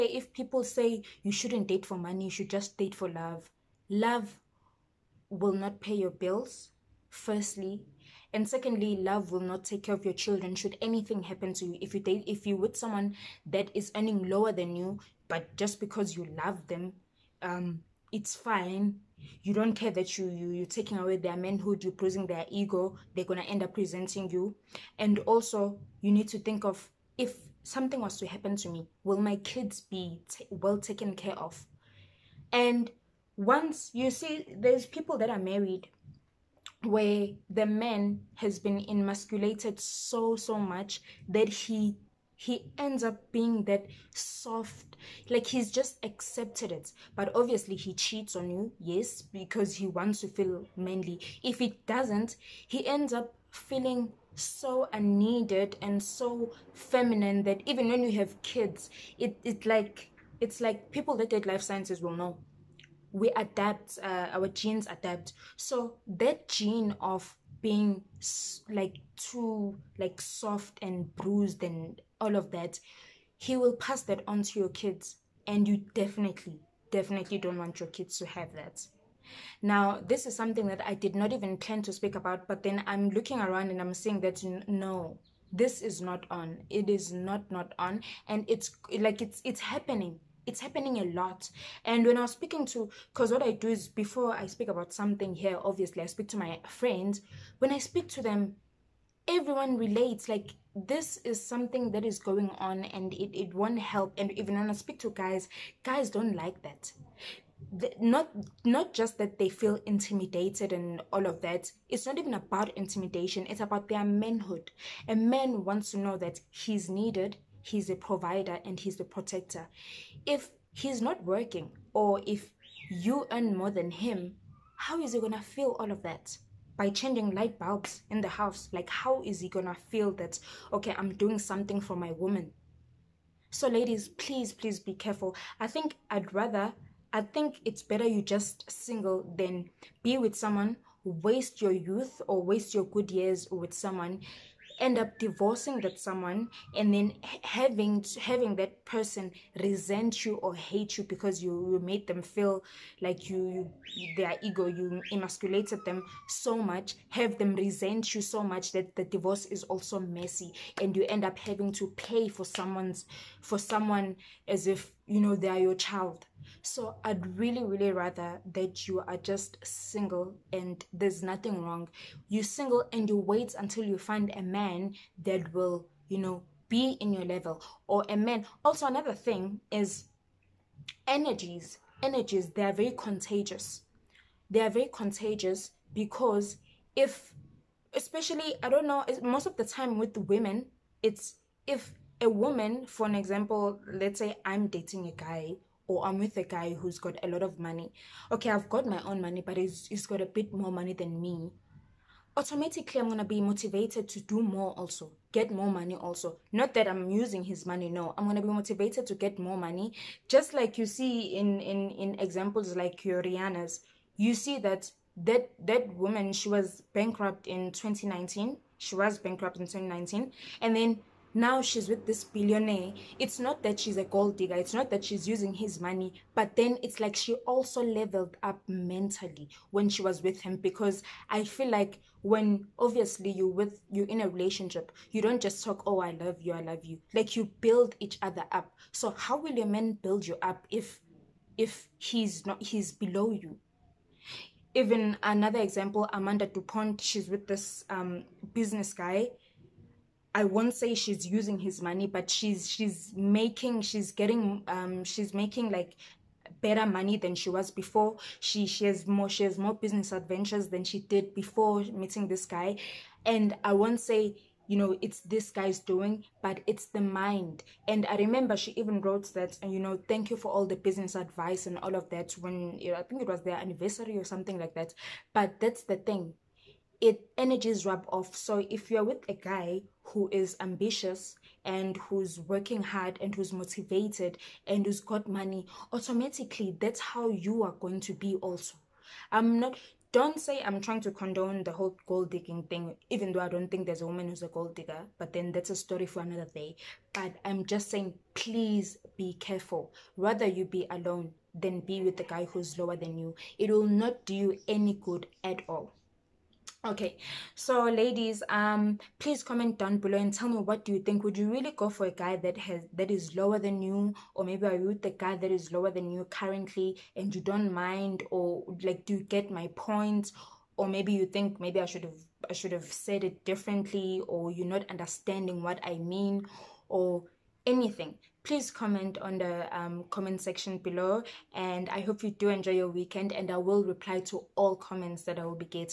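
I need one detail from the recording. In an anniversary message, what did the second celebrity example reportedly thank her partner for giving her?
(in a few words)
Business advice.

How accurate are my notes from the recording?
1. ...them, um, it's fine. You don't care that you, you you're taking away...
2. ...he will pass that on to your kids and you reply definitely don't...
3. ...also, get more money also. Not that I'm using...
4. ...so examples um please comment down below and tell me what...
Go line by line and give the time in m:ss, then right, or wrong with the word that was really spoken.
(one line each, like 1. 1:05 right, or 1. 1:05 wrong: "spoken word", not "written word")
1. 0:16 right
2. 1:13 wrong: "definitely", not "reply"
3. 3:24 right
4. 5:07 wrong: "ladies", not "examples".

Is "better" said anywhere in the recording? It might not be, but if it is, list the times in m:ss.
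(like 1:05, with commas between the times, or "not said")
2:17, 4:16.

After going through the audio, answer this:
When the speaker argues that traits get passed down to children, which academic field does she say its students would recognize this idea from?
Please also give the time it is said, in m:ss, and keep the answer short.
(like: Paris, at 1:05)
life sciences, at 1:01.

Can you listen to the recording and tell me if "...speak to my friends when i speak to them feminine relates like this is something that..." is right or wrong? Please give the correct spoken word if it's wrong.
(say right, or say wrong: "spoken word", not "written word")
wrong: "everyone", not "feminine".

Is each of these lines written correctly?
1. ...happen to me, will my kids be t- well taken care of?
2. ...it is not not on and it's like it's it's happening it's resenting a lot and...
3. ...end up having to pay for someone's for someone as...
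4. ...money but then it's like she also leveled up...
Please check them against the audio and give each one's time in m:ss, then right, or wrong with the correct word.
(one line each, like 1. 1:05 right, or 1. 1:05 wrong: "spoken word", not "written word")
1. 0:28 right
2. 1:26 wrong: "happening", not "resenting"
3. 2:41 right
4. 3:45 right.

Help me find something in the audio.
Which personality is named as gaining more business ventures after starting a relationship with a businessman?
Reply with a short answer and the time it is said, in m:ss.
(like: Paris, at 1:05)
Amanda du Pont, at 4:06.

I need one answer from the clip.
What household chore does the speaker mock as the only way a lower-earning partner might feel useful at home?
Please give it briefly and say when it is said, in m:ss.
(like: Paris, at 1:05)
Changing light bulbs, at 2:06.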